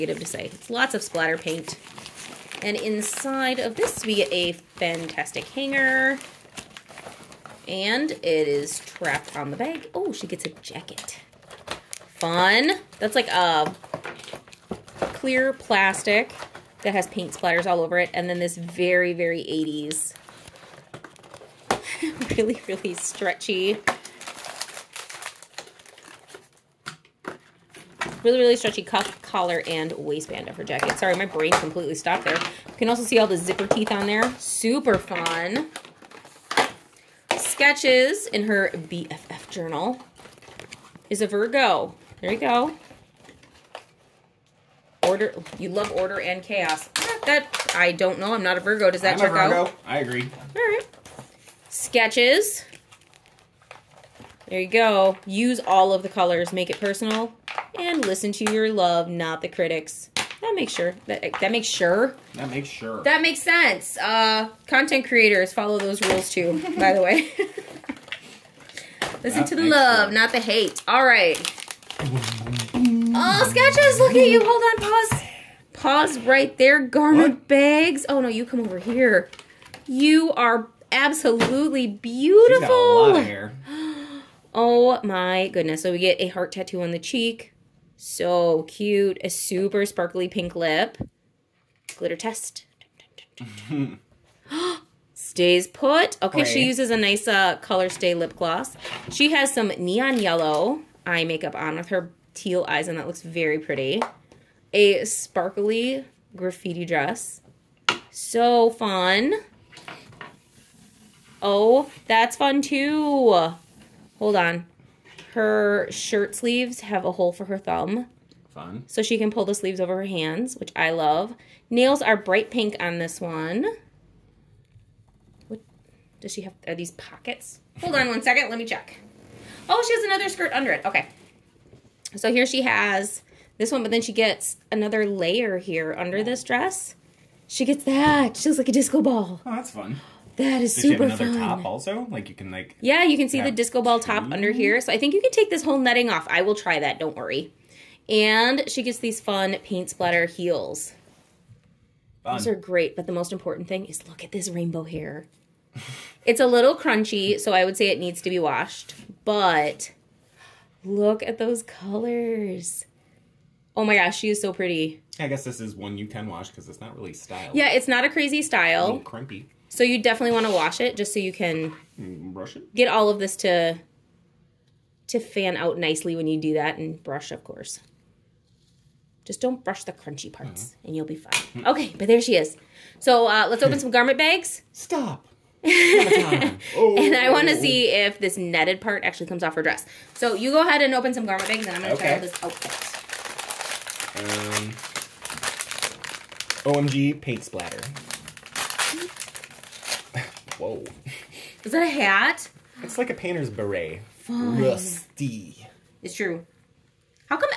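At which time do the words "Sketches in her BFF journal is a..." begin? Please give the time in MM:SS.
00:37.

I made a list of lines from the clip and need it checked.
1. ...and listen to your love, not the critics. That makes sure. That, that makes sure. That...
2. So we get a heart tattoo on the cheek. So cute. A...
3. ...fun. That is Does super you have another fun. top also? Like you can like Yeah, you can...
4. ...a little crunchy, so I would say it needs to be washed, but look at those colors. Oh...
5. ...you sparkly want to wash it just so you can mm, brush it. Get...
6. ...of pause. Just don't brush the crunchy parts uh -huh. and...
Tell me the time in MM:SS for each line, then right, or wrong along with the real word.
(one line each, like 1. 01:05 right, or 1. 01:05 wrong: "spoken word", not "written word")
1. 00:57 right
2. 01:25 right
3. 02:19 right
4. 02:36 right
5. 02:49 wrong: "definitely", not "sparkly"
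6. 02:57 wrong: "course", not "pause".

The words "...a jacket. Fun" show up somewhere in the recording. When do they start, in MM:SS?
00:10.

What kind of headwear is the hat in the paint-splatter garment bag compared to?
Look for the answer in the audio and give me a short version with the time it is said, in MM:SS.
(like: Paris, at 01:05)
A painter's beret, at 03:23.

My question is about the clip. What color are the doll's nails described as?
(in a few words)
Bright pink.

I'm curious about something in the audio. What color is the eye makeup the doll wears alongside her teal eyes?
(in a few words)
Neon yellow.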